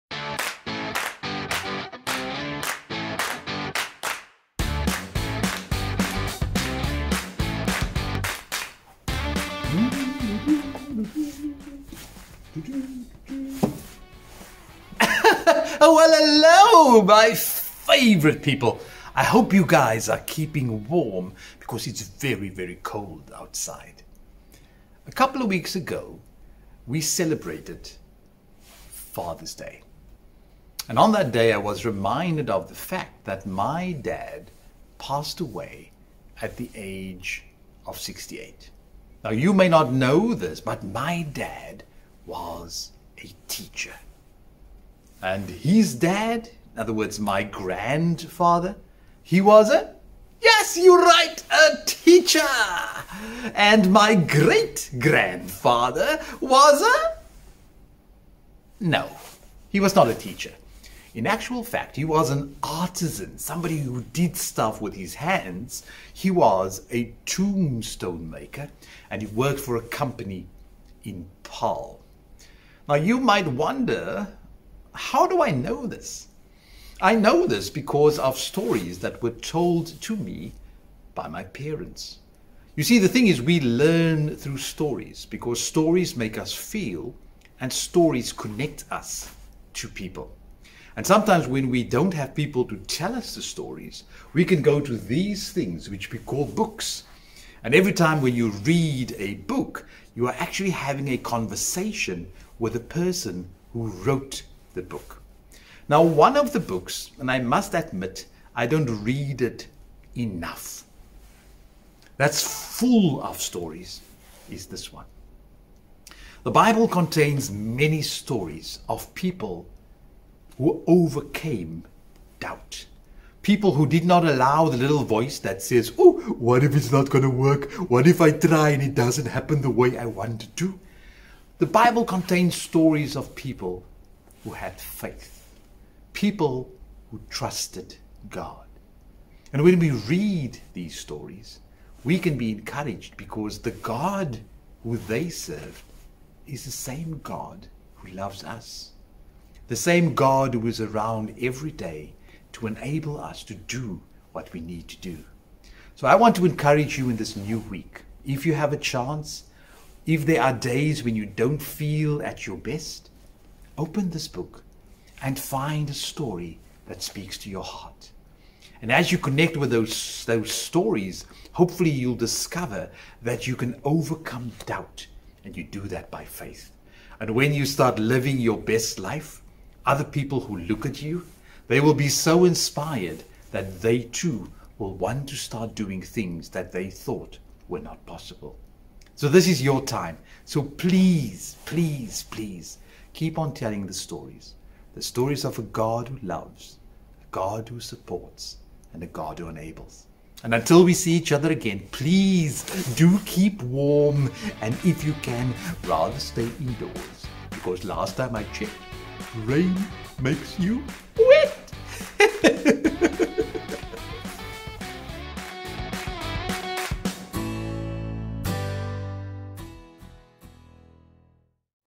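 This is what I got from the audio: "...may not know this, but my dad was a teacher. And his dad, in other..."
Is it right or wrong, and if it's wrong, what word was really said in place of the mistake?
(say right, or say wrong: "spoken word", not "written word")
right.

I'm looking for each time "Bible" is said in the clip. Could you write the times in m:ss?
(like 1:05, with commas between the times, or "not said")
1:56, 2:11.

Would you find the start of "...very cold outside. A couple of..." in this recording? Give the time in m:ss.
0:22.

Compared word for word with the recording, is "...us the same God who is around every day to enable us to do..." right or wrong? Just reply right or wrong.
right.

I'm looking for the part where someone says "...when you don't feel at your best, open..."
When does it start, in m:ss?
2:41.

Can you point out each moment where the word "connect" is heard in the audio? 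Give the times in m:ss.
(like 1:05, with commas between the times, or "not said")
1:28, 2:49.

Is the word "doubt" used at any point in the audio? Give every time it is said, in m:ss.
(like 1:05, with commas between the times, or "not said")
2:02, 2:54.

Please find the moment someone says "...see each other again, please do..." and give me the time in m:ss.
3:20.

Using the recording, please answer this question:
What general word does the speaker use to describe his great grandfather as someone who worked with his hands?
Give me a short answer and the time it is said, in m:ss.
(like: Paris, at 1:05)
artisan, at 1:02.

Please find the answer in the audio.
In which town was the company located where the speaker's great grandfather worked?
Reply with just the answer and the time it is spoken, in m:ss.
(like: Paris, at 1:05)
Paarl, at 1:11.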